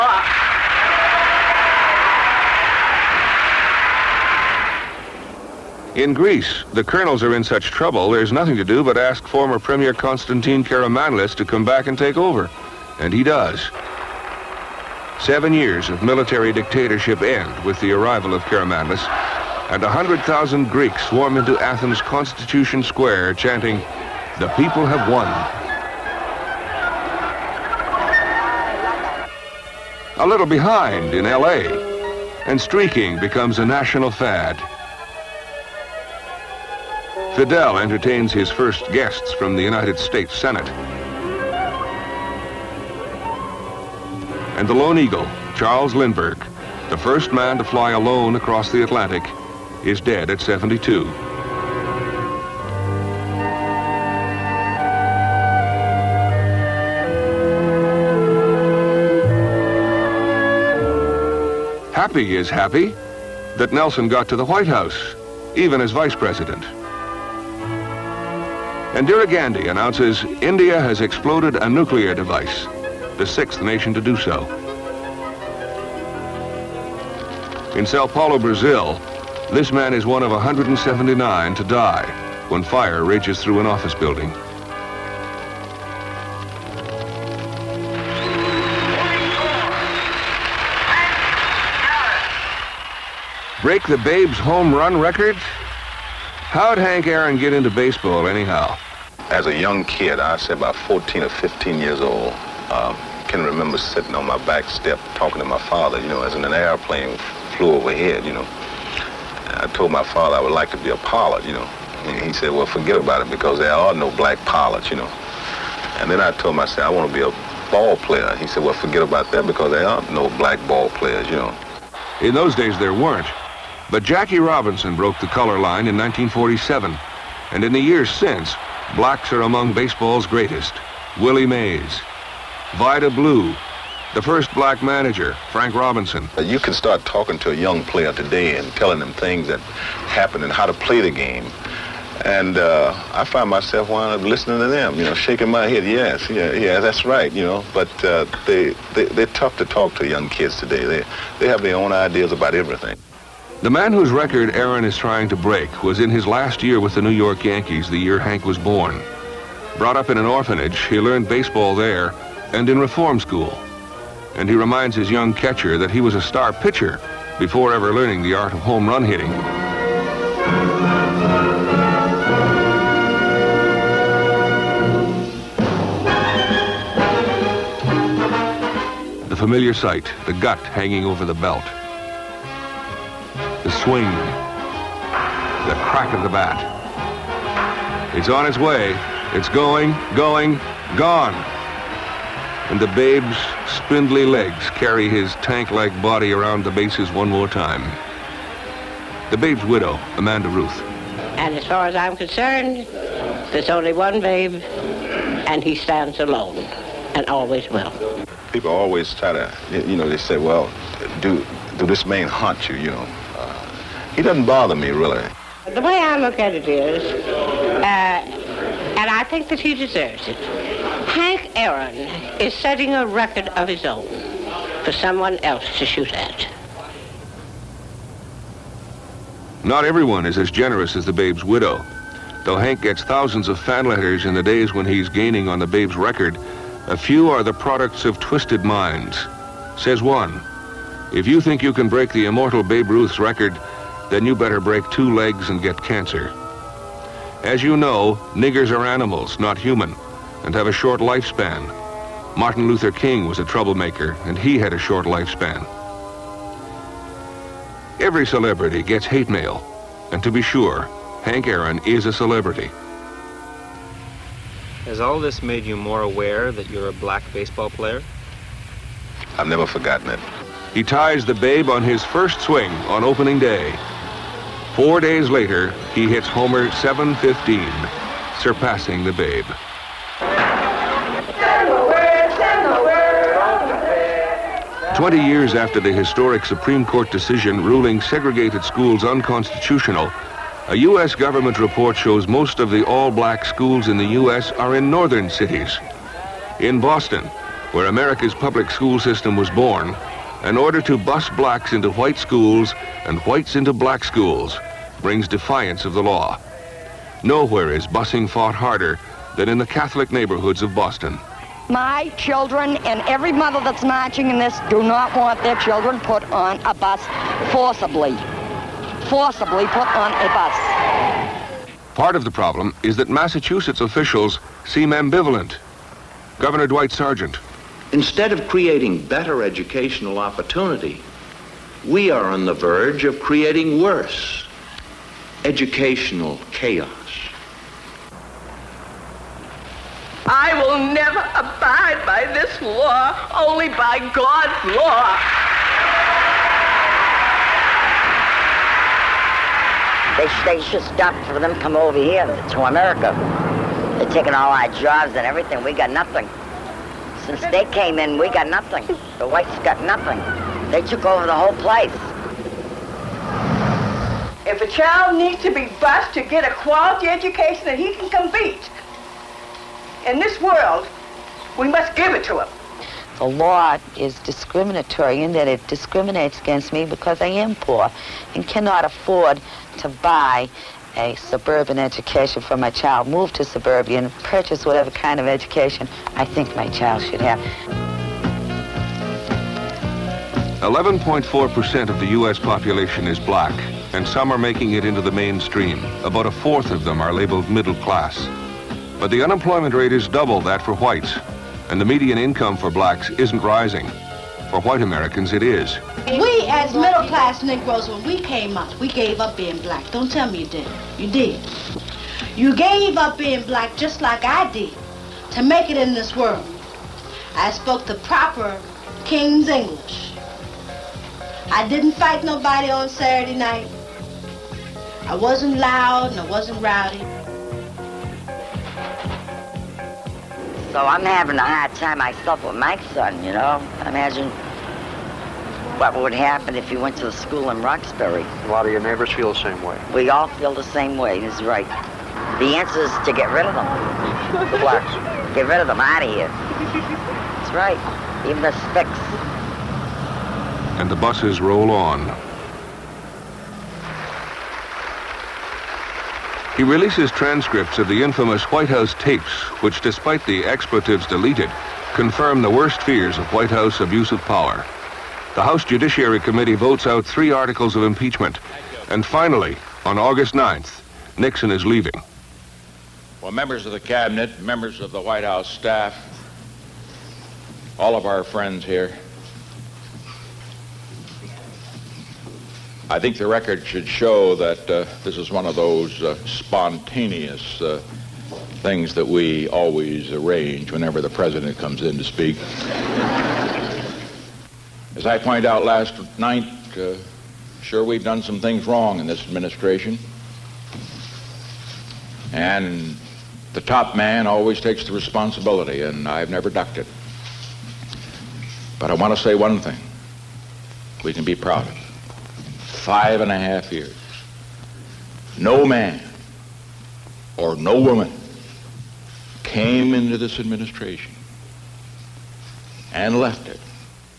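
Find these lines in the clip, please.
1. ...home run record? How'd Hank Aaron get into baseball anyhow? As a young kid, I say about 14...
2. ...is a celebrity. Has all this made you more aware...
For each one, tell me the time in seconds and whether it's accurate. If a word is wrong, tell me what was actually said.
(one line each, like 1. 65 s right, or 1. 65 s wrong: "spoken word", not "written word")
1. 94 s right
2. 261 s right.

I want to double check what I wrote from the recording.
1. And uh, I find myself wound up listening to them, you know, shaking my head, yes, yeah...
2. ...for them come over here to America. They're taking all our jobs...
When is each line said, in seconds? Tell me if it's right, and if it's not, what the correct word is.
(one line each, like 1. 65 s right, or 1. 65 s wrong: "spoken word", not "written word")
1. 142 s right
2. 351 s right.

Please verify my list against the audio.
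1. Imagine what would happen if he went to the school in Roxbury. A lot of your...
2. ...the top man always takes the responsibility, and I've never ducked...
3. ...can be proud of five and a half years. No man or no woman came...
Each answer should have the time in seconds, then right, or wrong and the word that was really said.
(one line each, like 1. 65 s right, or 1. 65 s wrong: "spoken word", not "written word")
1. 433 s right
2. 503 s right
3. 511 s right.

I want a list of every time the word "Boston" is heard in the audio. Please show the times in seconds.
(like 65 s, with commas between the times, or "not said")
296 s, 310 s.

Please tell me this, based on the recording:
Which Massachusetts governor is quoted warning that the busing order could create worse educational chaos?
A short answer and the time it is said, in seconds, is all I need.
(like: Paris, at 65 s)
Dwight Sargent, at 326 s.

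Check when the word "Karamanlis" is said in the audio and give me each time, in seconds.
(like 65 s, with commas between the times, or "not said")
10 s, 18 s.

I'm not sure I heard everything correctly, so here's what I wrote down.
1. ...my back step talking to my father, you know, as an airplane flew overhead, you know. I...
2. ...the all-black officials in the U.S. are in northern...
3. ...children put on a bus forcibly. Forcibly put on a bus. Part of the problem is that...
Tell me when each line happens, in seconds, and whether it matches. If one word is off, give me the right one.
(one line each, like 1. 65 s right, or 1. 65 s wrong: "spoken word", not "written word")
1. 104 s right
2. 292 s wrong: "schools", not "officials"
3. 315 s right.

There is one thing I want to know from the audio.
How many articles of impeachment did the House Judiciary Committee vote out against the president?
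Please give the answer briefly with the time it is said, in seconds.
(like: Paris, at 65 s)
3, at 467 s.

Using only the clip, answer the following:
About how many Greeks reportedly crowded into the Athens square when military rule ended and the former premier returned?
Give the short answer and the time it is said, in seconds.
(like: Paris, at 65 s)
100,000, at 19 s.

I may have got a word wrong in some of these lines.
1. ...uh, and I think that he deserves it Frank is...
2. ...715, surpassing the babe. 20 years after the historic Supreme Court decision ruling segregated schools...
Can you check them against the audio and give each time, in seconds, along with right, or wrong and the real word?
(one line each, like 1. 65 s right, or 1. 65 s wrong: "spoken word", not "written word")
1. 217 s wrong: "Aaron", not "Frank"
2. 276 s right.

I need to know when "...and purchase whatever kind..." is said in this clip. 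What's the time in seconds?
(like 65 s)
383 s.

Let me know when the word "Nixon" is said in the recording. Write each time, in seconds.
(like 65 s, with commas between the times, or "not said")
471 s.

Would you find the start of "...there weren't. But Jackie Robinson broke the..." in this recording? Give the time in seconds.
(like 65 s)
122 s.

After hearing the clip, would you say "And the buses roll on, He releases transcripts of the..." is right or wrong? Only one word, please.
right.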